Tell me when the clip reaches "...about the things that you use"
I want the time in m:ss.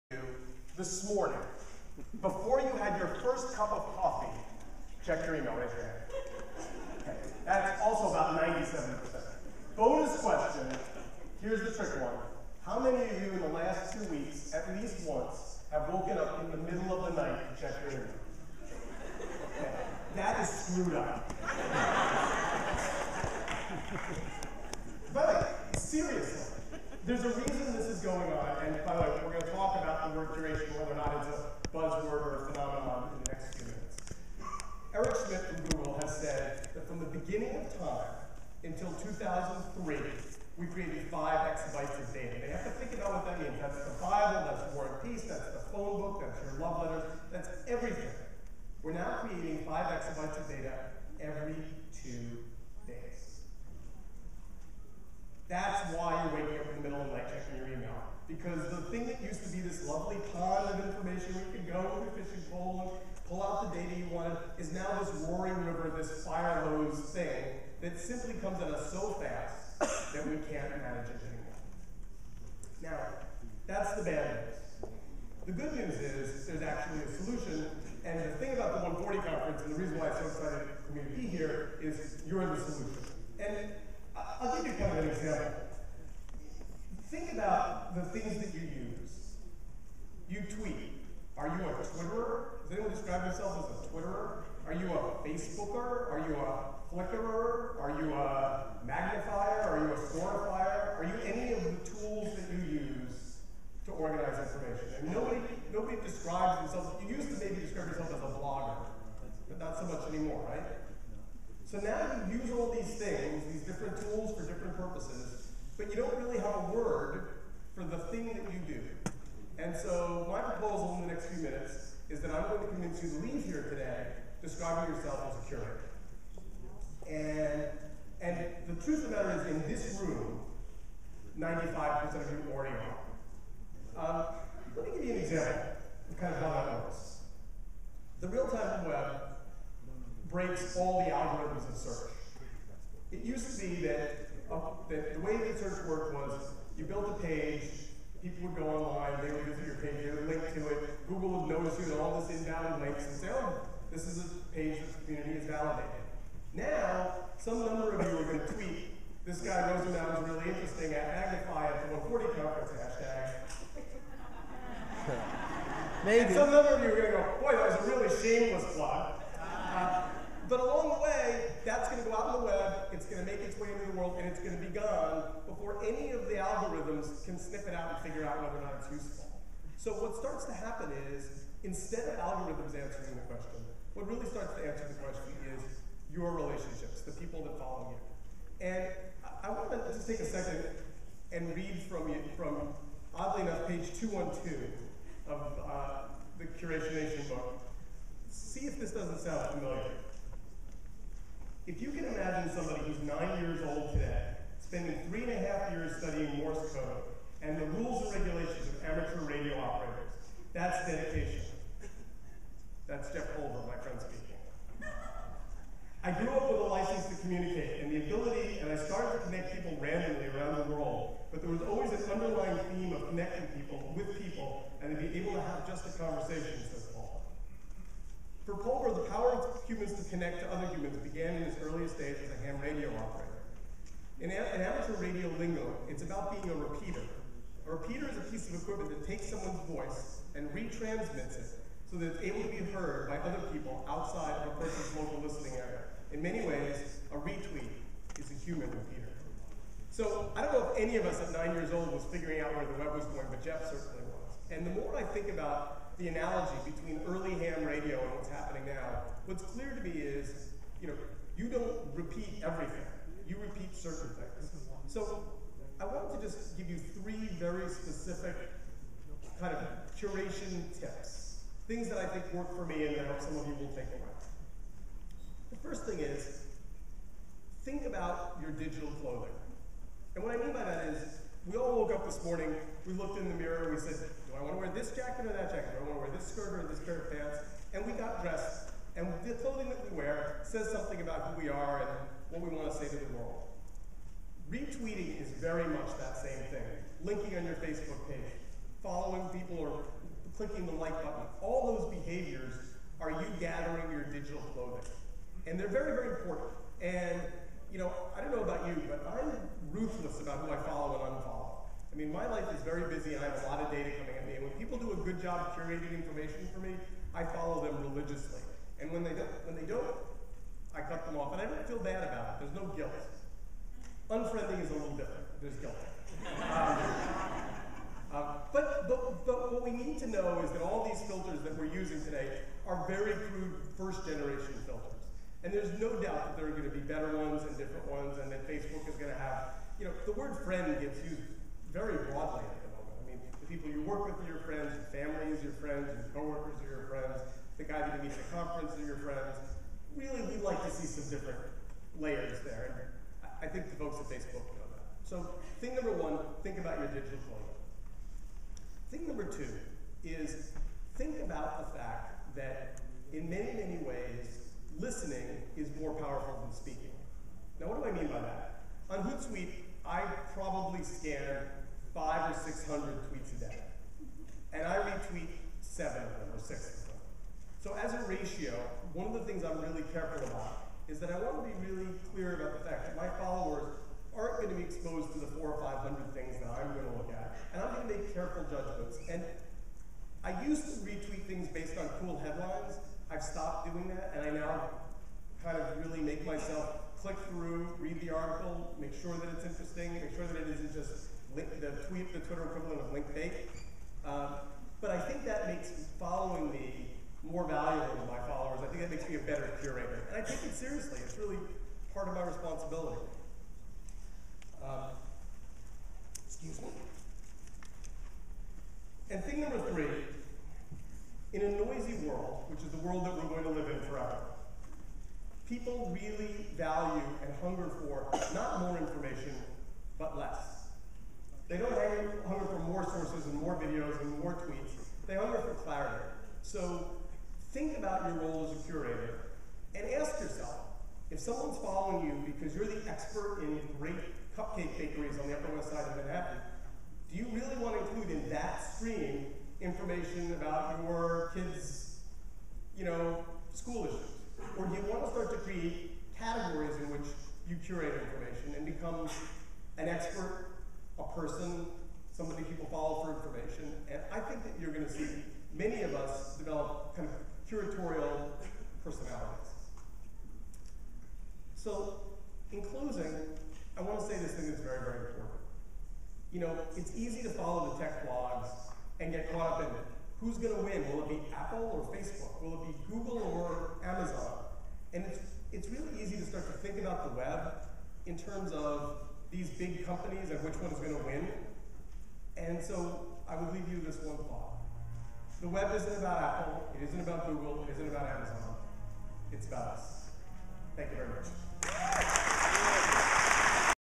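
1:27.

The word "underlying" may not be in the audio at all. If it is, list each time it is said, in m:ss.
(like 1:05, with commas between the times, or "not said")
3:42.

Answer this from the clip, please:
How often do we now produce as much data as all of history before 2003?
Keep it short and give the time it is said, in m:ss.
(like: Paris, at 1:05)
every 2 days, at 0:51.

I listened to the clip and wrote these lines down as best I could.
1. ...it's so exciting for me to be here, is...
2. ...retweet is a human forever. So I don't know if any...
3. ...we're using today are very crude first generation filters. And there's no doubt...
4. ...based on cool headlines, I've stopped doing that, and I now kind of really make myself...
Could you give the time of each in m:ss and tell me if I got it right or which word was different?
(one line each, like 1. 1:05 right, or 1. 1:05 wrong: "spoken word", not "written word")
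1. 1:20 right
2. 4:07 wrong: "repeater", not "forever"
3. 5:31 right
4. 6:31 right.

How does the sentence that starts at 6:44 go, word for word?
Um, but I think that makes following me more valuable to my followers.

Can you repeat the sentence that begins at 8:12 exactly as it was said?
And so I would leave you this one thought.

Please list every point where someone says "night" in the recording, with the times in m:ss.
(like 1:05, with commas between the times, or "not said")
0:17, 0:57.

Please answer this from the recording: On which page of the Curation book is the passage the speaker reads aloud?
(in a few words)
212.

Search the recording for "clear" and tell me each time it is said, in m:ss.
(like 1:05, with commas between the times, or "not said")
4:19, 6:22.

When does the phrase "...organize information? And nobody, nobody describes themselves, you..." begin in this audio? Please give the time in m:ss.
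1:43.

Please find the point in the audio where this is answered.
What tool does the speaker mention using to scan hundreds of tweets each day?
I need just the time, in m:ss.
6:09.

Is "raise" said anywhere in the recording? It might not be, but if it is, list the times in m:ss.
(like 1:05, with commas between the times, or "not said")
0:05.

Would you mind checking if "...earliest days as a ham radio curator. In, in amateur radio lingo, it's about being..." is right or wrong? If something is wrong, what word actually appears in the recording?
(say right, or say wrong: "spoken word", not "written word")
wrong: "operator", not "curator".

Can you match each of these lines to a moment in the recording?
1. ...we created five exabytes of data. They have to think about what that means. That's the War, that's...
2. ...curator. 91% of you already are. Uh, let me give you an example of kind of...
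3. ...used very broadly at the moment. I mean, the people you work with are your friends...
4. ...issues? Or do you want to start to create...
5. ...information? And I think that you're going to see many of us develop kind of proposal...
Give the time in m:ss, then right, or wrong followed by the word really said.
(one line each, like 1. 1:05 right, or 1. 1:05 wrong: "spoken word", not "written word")
1. 0:40 wrong: "Bible", not "War"
2. 2:05 wrong: "95", not "91"
3. 5:41 right
4. 7:33 right
5. 7:43 wrong: "curatorial", not "proposal".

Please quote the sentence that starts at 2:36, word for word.
Now, some number of you this guy Rosenbaum was really interesting at Magnify at the 140 conference hashtag.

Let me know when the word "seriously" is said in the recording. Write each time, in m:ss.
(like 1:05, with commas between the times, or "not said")
6:50.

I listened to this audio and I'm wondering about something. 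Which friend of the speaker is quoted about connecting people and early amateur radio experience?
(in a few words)
Jeff Pulver.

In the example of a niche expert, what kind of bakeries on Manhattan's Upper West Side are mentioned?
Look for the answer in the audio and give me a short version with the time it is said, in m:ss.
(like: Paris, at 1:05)
cupcake bakeries, at 7:24.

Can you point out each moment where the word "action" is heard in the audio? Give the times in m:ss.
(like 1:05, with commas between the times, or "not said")
not said.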